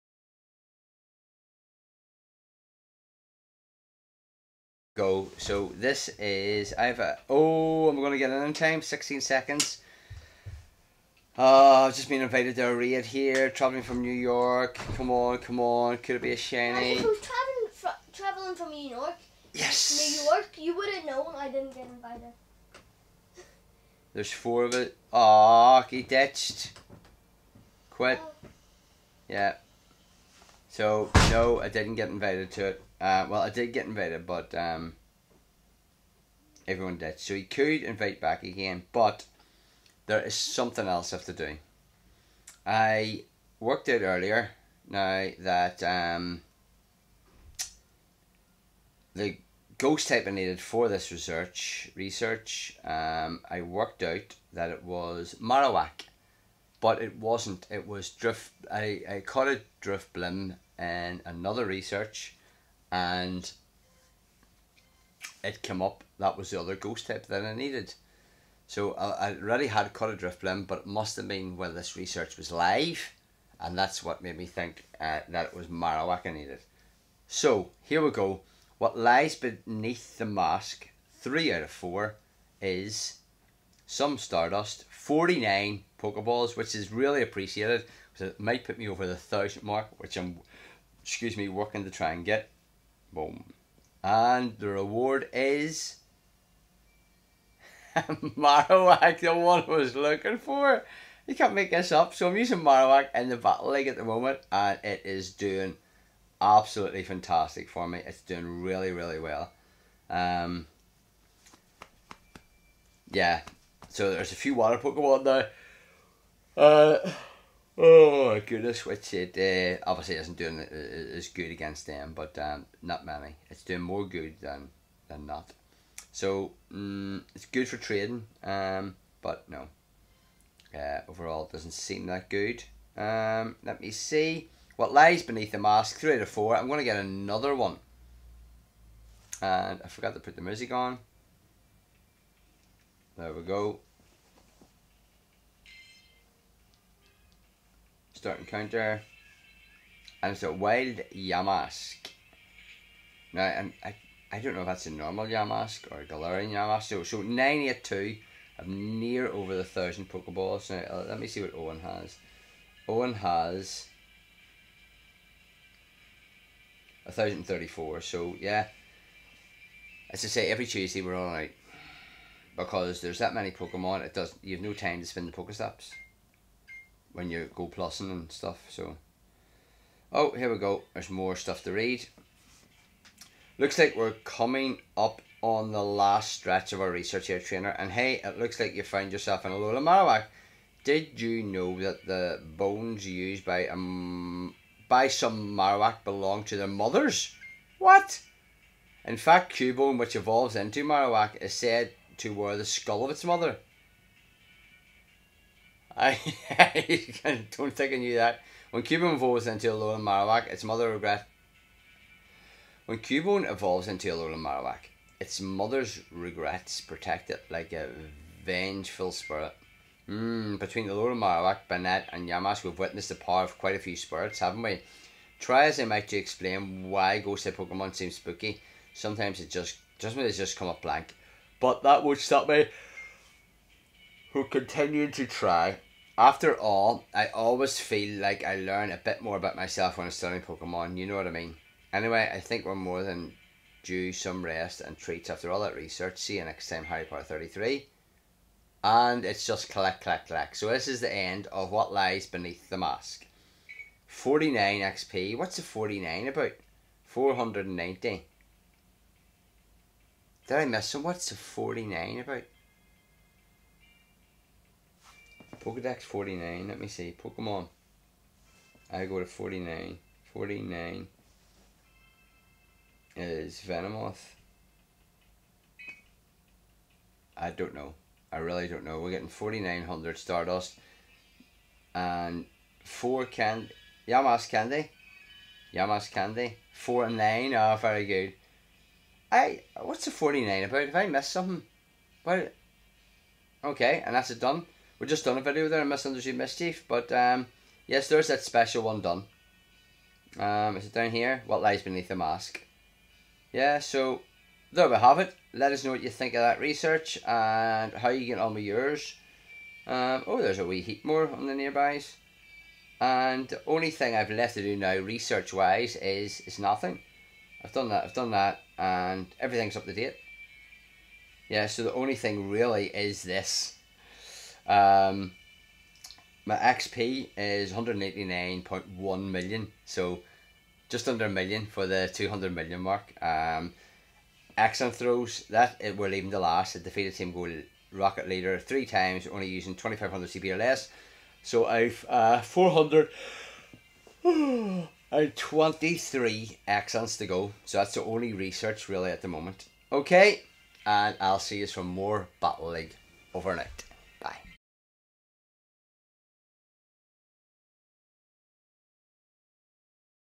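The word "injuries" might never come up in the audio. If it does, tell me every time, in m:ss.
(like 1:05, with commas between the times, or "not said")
not said.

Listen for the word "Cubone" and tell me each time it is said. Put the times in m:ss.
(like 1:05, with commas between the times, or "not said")
3:19, 3:28, 3:32.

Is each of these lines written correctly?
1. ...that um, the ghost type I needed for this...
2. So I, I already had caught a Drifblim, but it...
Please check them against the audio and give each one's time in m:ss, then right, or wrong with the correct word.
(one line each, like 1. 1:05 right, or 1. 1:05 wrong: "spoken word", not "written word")
1. 0:45 right
2. 1:08 right.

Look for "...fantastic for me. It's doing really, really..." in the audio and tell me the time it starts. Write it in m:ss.
1:47.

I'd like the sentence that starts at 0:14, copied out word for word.
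Come on, come on, could it be a shiny?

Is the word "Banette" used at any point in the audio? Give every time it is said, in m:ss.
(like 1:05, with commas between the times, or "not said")
3:41.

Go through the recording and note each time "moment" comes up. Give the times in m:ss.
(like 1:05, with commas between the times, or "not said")
1:44, 5:49.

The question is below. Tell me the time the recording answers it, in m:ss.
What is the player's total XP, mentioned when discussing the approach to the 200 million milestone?
5:27.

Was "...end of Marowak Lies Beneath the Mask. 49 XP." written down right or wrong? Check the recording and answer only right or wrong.
wrong.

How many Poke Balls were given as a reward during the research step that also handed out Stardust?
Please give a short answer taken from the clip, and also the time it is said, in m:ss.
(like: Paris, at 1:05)
49, at 1:24.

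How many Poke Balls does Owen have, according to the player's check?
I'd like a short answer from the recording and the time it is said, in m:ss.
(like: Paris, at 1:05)
1,034, at 2:47.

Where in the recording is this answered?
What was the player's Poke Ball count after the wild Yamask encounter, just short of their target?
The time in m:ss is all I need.
2:37.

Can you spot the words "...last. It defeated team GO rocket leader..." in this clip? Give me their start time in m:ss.
5:36.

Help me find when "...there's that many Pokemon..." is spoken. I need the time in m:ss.
2:53.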